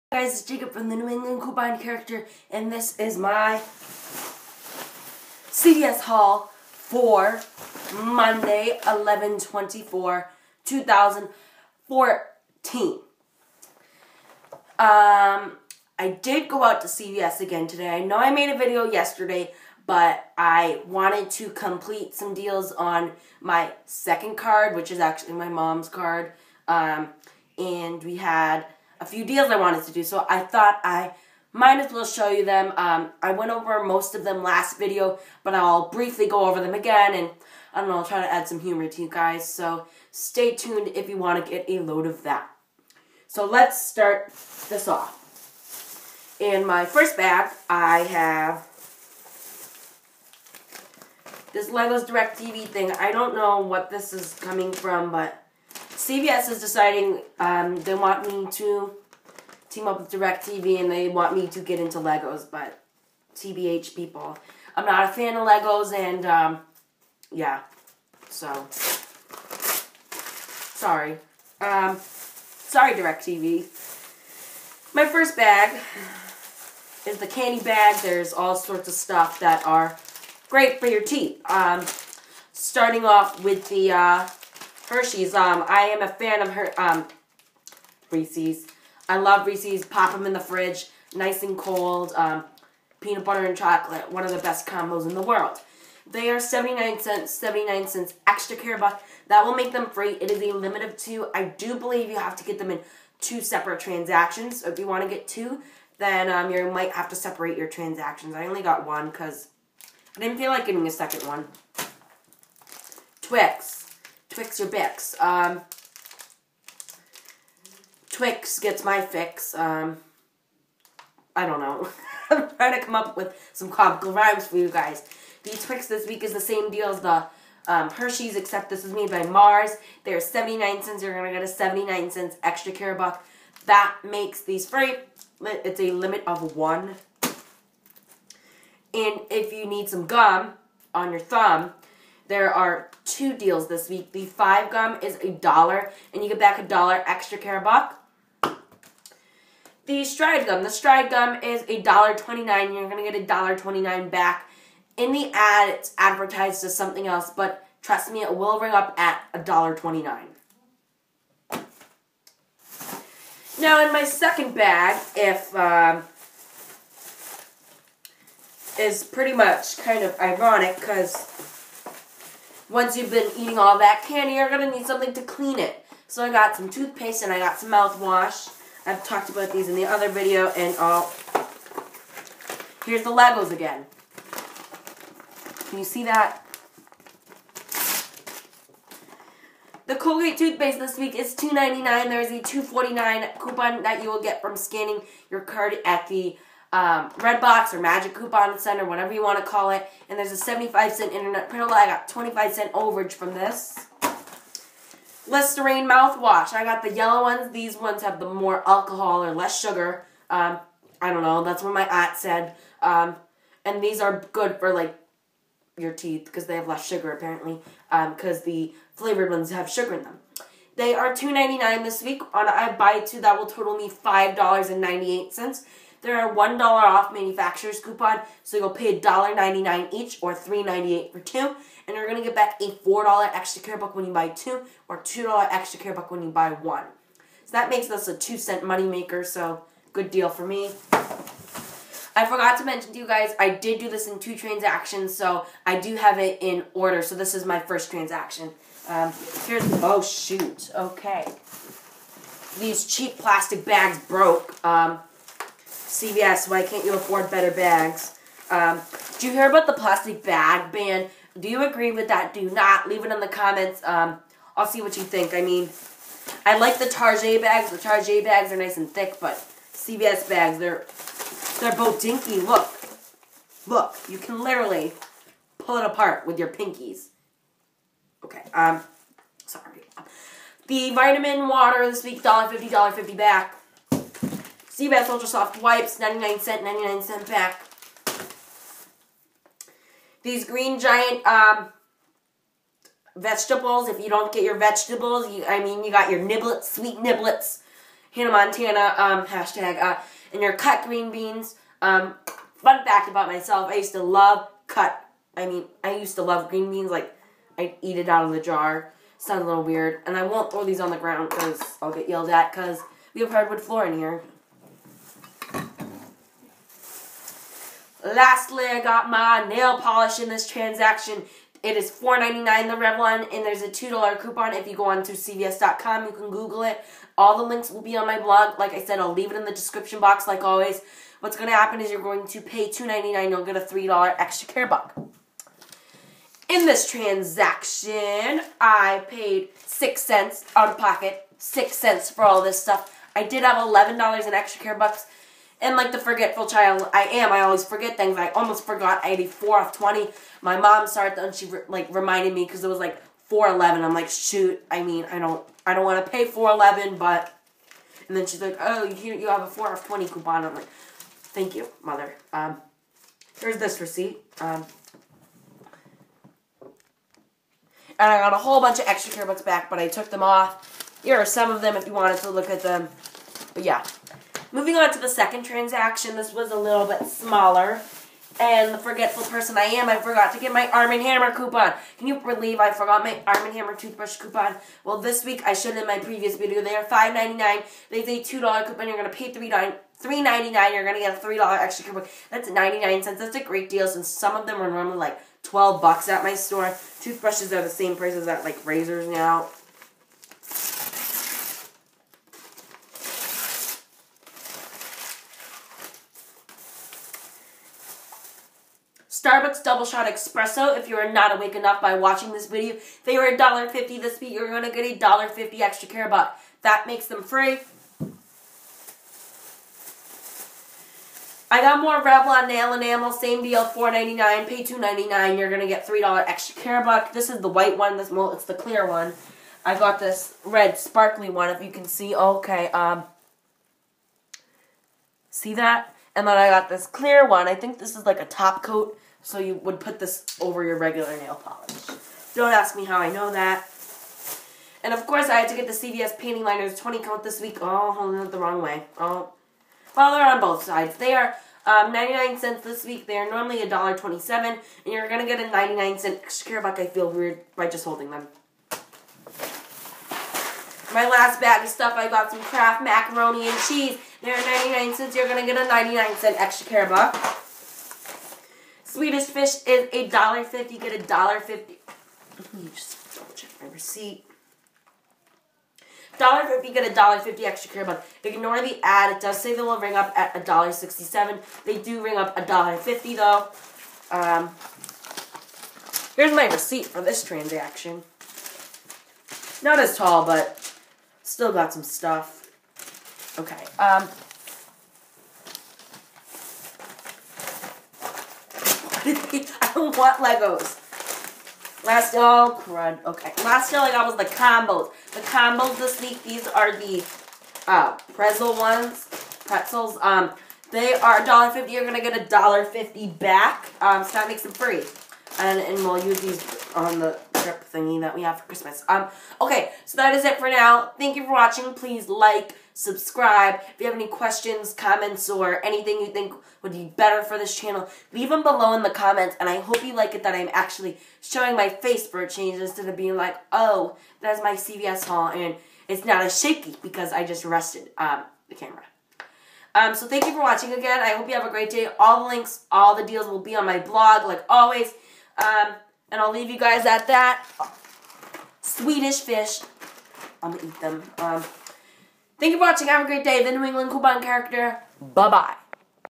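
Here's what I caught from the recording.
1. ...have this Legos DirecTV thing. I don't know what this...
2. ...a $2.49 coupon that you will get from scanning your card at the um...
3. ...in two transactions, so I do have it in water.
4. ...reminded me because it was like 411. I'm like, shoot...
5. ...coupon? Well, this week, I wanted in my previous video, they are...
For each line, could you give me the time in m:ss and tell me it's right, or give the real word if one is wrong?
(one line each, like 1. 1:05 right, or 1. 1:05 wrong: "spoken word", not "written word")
1. 0:47 right
2. 3:12 right
3. 4:04 wrong: "order", not "water"
4. 5:51 right
5. 6:24 wrong: "showed", not "wanted".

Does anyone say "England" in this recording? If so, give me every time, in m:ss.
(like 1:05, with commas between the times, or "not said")
0:01, 9:13.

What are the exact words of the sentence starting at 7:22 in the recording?
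Don't ask me how I know that.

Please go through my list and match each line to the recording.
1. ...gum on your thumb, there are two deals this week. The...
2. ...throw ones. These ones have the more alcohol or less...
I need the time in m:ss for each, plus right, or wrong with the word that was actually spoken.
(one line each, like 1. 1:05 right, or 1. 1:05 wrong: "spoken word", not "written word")
1. 2:20 right
2. 3:26 wrong: "yellow", not "throw".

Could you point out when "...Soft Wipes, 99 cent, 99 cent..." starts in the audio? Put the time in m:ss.
4:45.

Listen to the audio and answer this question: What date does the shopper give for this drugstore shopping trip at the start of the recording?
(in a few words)
11-24-2014.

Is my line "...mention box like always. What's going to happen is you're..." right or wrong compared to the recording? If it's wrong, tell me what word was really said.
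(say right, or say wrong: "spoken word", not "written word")
wrong: "description", not "mention".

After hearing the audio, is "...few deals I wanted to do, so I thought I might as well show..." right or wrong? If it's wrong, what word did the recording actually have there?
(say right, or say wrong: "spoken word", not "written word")
right.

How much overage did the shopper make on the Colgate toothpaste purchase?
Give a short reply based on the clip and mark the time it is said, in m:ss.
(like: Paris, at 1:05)
25 cents, at 3:22.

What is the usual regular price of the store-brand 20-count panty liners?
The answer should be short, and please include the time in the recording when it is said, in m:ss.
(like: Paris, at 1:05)
$1.27, at 7:33.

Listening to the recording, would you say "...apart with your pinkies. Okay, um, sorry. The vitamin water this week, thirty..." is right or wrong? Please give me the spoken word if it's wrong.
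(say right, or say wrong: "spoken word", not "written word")
wrong: "fifty", not "thirty".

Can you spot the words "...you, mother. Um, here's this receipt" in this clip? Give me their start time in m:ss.
6:01.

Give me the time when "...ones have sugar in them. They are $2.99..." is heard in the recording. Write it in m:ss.
3:39.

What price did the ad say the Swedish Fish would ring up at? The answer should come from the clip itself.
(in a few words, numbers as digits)
$1.67.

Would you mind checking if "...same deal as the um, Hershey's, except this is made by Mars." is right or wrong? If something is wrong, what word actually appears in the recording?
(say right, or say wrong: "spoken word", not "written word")
right.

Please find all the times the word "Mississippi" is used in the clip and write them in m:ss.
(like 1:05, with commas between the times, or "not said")
not said.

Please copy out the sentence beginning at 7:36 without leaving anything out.
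I feel weird by just holding them.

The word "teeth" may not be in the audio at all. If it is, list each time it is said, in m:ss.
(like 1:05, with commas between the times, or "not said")
1:21, 3:35.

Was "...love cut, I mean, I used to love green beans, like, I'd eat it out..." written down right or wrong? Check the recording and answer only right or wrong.
right.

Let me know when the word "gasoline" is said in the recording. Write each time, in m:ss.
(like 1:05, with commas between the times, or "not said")
not said.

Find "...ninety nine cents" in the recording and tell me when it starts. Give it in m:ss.
6:32.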